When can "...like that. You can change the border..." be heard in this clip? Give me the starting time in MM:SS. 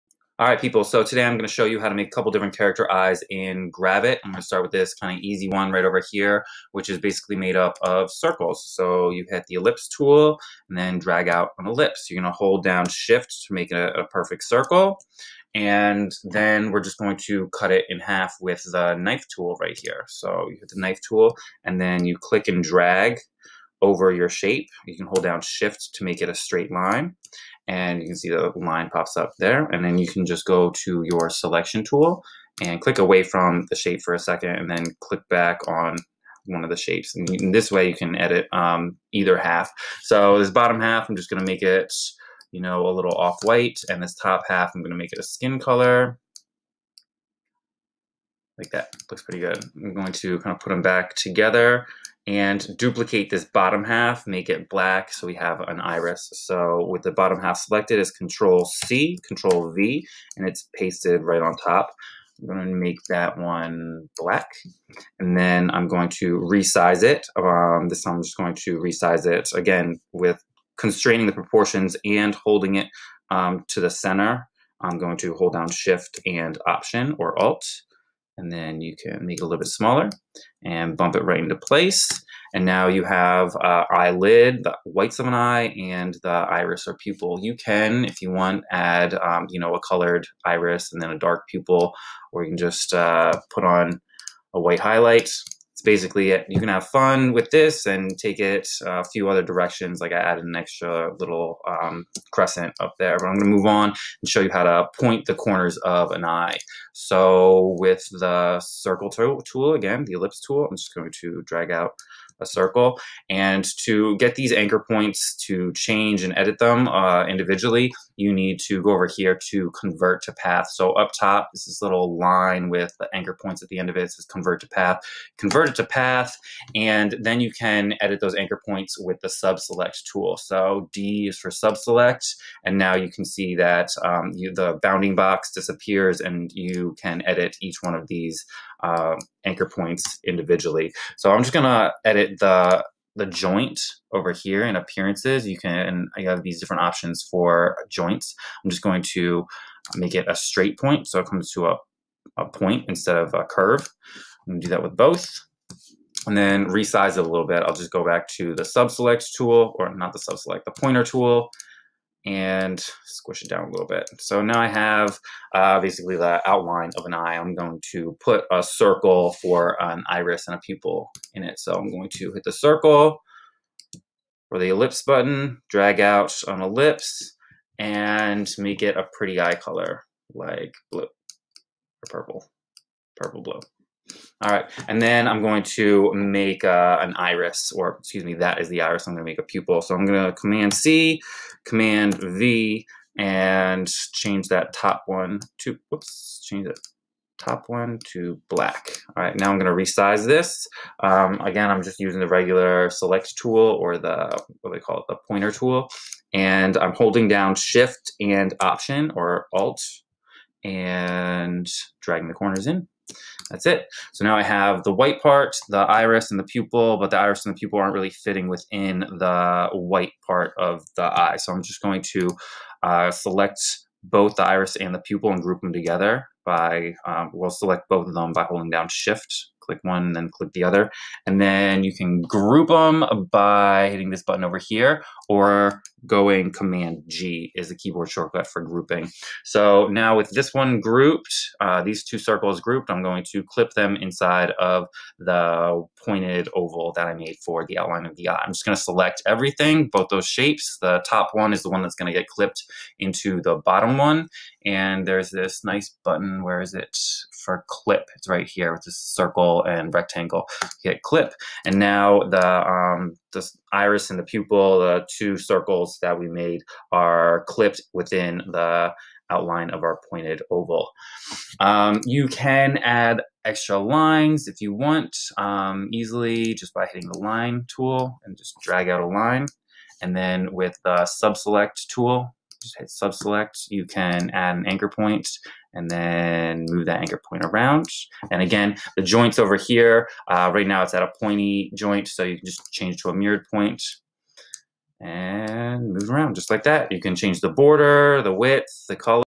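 04:56.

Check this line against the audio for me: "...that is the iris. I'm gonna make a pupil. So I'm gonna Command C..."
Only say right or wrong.
right.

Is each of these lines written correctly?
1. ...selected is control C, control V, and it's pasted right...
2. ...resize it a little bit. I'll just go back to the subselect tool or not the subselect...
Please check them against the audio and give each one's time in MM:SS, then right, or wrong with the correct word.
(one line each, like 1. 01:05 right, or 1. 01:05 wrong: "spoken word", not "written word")
1. 00:57 right
2. 02:36 right.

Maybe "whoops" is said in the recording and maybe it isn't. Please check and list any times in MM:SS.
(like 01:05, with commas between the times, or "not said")
03:15.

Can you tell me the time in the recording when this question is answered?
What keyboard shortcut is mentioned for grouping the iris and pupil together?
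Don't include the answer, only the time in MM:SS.
03:56.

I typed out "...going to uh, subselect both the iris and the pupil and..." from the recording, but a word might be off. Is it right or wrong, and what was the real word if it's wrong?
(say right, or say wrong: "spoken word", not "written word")
wrong: "select", not "subselect".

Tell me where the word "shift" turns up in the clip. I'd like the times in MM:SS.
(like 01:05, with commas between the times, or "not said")
00:12, 00:25, 01:15, 03:27, 03:48.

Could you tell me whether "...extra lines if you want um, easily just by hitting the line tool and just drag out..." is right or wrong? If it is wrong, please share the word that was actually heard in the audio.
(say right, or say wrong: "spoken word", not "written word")
right.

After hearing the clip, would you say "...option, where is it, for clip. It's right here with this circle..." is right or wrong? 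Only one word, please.
wrong.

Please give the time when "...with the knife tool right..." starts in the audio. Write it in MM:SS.
00:18.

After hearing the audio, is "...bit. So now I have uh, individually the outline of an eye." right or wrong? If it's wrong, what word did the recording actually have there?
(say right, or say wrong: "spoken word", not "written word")
wrong: "basically", not "individually".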